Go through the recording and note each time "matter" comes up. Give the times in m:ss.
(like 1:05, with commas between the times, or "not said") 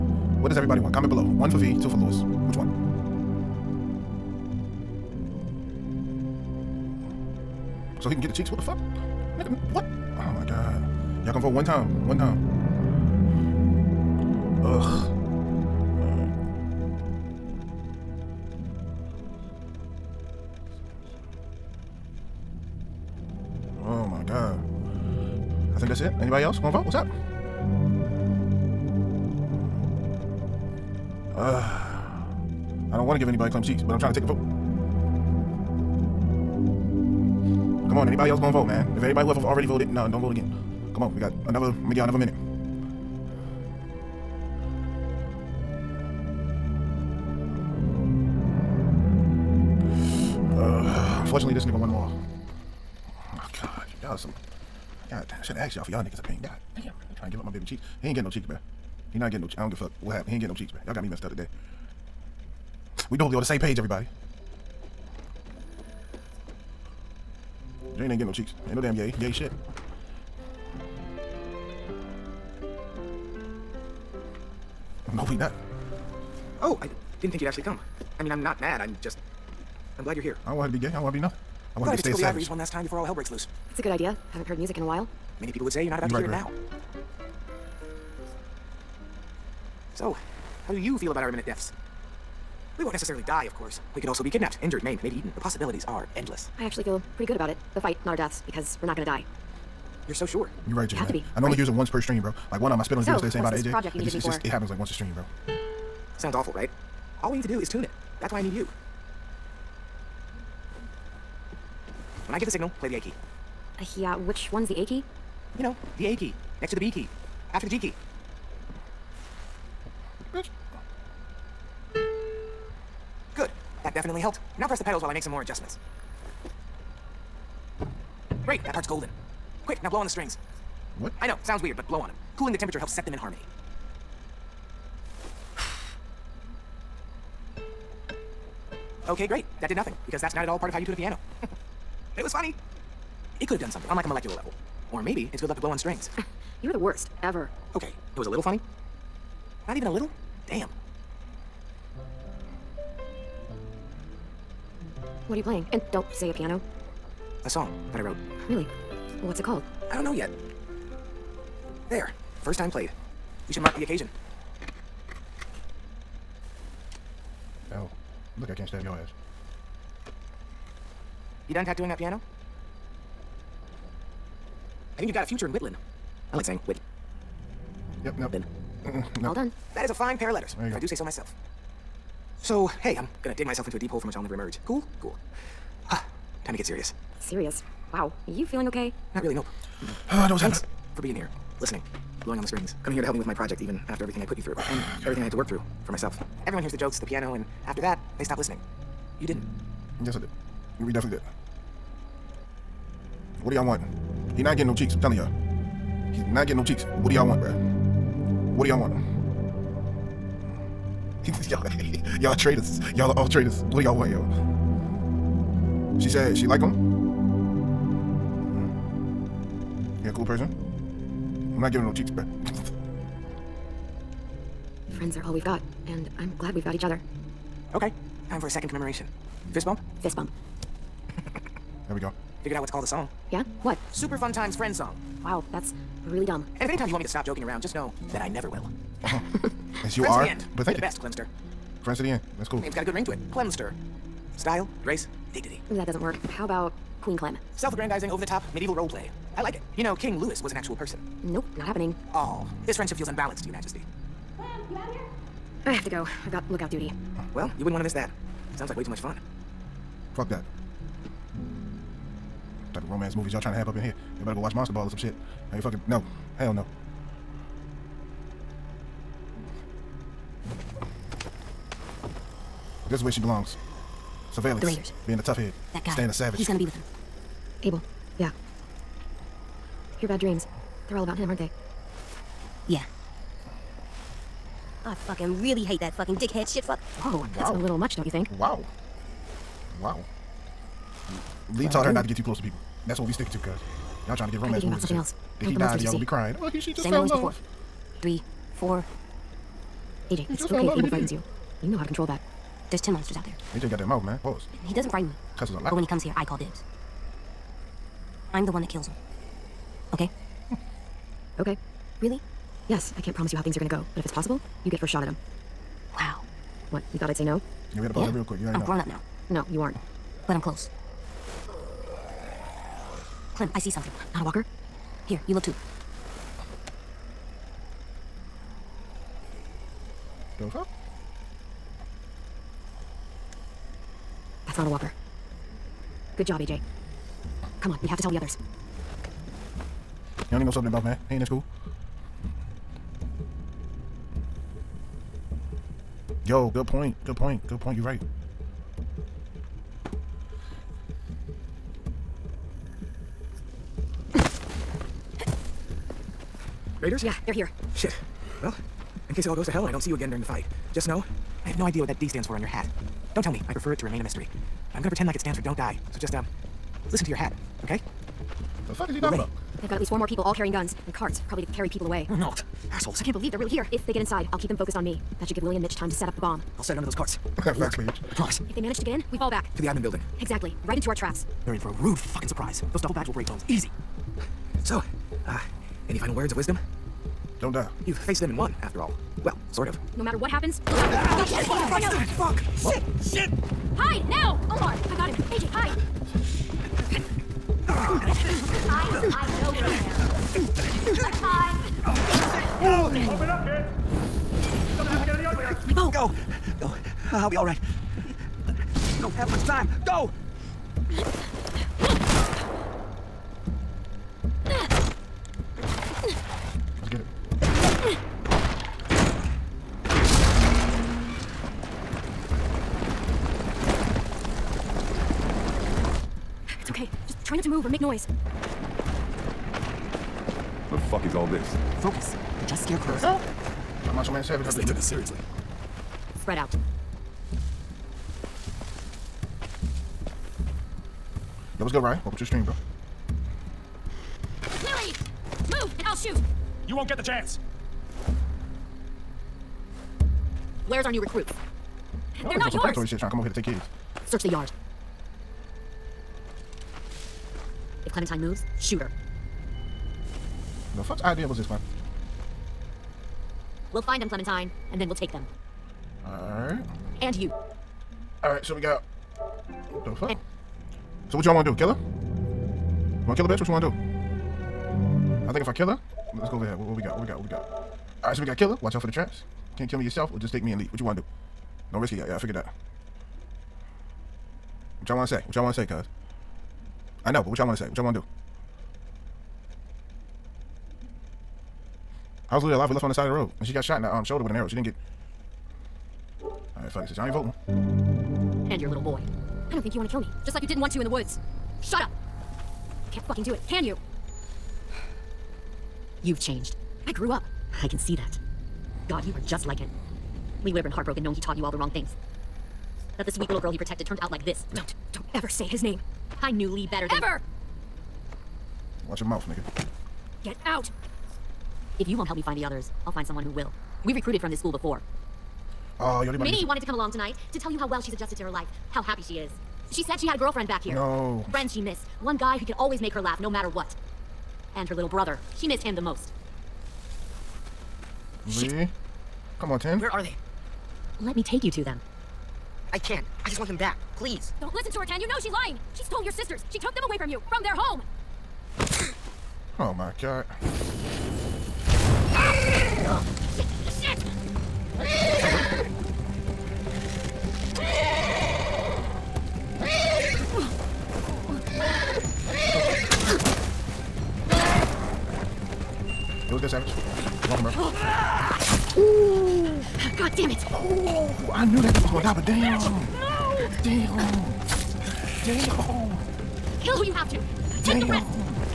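6:30, 8:53.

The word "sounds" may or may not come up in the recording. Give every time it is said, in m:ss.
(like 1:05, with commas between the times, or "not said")
1:46, 2:11, 4:18.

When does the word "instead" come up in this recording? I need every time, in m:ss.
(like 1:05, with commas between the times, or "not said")
1:43.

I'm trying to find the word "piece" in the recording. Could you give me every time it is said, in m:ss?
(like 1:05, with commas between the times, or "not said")
not said.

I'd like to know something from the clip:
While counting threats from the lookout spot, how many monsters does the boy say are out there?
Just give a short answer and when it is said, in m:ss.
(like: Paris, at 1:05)
10, at 5:02.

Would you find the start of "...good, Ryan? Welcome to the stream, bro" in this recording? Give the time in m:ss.
7:21.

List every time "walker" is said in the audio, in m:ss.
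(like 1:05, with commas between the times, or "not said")
5:24, 5:34.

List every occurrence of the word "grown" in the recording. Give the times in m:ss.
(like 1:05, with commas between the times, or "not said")
5:18.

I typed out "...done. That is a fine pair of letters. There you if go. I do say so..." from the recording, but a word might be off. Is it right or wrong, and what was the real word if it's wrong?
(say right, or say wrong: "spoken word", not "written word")
right.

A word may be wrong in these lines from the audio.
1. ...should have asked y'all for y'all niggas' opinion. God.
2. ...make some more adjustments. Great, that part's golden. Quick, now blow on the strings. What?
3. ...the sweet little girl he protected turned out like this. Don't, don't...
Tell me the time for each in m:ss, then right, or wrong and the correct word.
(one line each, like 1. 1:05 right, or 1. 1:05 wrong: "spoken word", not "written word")
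1. 0:55 right
2. 2:05 right
3. 8:33 right.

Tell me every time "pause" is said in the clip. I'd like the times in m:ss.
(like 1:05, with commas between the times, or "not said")
5:04, 5:17.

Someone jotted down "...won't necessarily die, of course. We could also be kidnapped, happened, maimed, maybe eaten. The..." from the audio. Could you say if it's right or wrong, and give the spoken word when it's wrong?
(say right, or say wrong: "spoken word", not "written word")
wrong: "injured", not "happened".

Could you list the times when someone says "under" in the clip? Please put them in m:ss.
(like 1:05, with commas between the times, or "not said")
6:16.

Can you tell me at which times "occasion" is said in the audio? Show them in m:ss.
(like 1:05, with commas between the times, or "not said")
2:43.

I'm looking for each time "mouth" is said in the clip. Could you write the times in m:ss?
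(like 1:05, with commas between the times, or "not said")
5:03, 5:40, 8:39.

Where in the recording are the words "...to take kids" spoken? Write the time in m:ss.
7:33.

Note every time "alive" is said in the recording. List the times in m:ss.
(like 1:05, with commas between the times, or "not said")
8:12.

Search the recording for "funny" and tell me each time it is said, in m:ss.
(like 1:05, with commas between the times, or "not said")
2:22, 2:28.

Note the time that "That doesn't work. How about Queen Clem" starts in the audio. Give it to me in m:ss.
4:05.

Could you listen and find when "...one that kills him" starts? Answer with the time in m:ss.
5:08.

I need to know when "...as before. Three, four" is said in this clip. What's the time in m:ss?
4:57.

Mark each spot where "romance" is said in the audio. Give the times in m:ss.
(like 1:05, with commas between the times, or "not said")
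4:22, 4:54.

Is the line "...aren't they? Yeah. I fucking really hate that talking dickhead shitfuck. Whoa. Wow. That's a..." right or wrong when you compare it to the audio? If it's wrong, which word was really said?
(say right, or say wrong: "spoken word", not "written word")
wrong: "fucking", not "talking".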